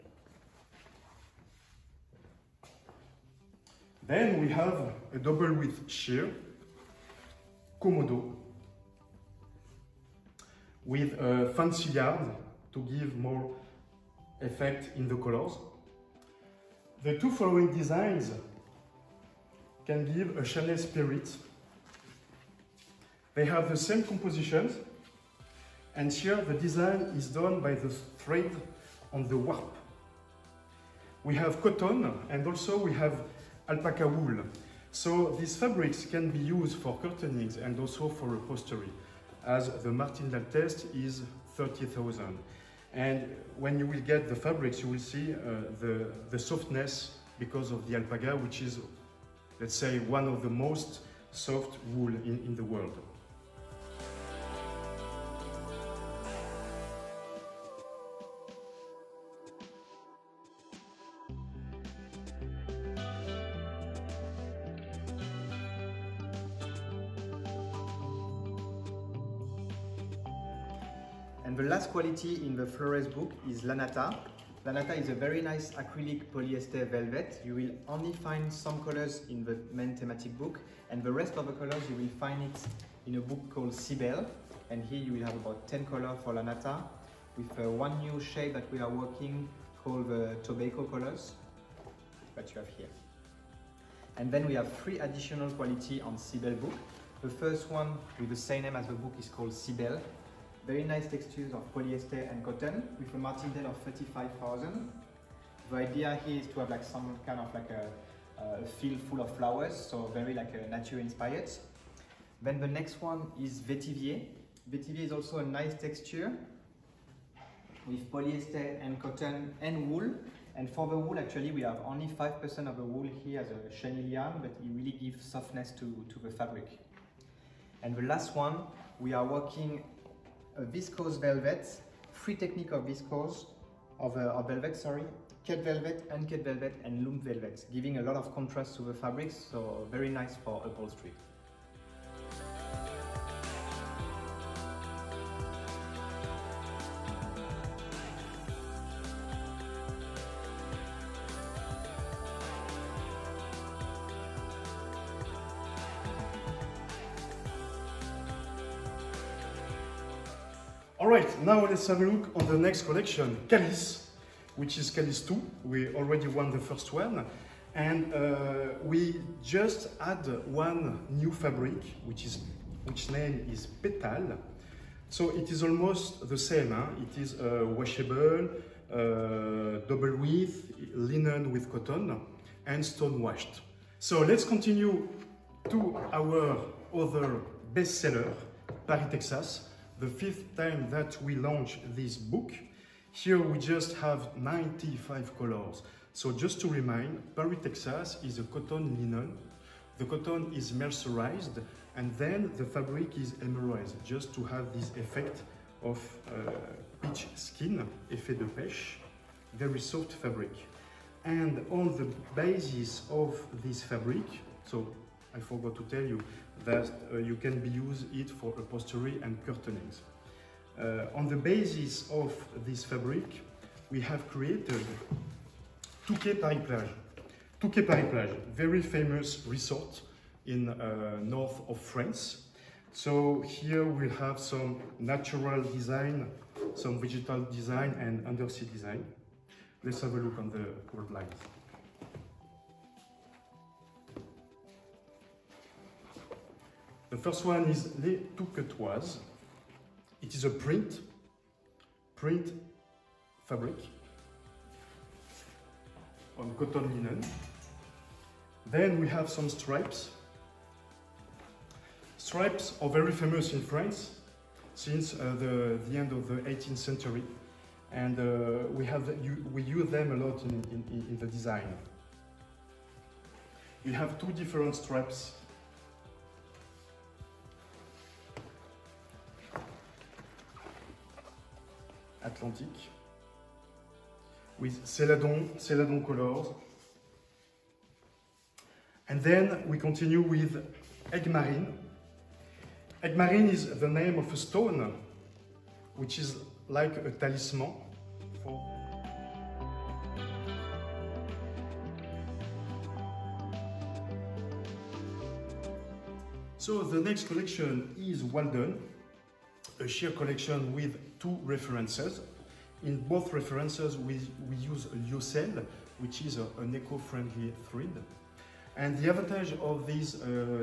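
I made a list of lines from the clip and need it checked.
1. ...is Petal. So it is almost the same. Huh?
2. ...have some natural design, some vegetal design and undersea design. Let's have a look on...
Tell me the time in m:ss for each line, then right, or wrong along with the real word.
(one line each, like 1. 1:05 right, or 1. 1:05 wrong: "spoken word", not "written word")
1. 2:53 right
2. 3:54 right.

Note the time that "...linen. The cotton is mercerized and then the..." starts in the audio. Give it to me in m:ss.
3:19.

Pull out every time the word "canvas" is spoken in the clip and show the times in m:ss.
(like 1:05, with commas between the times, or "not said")
not said.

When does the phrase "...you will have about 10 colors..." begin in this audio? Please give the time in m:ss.
1:25.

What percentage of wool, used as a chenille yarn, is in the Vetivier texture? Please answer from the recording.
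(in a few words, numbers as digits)
5%.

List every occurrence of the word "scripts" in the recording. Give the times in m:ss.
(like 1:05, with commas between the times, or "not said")
not said.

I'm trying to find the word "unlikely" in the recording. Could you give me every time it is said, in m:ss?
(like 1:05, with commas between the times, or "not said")
not said.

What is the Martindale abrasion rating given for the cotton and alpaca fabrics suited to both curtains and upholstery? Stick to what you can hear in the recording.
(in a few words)
30,000.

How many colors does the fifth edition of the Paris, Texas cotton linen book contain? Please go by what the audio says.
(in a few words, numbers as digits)
95.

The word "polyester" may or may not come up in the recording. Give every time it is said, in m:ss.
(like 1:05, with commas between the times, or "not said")
1:16, 1:41, 1:58.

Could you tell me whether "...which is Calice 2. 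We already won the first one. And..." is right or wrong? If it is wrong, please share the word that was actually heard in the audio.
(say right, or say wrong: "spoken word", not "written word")
right.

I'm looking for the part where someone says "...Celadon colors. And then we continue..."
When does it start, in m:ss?
4:45.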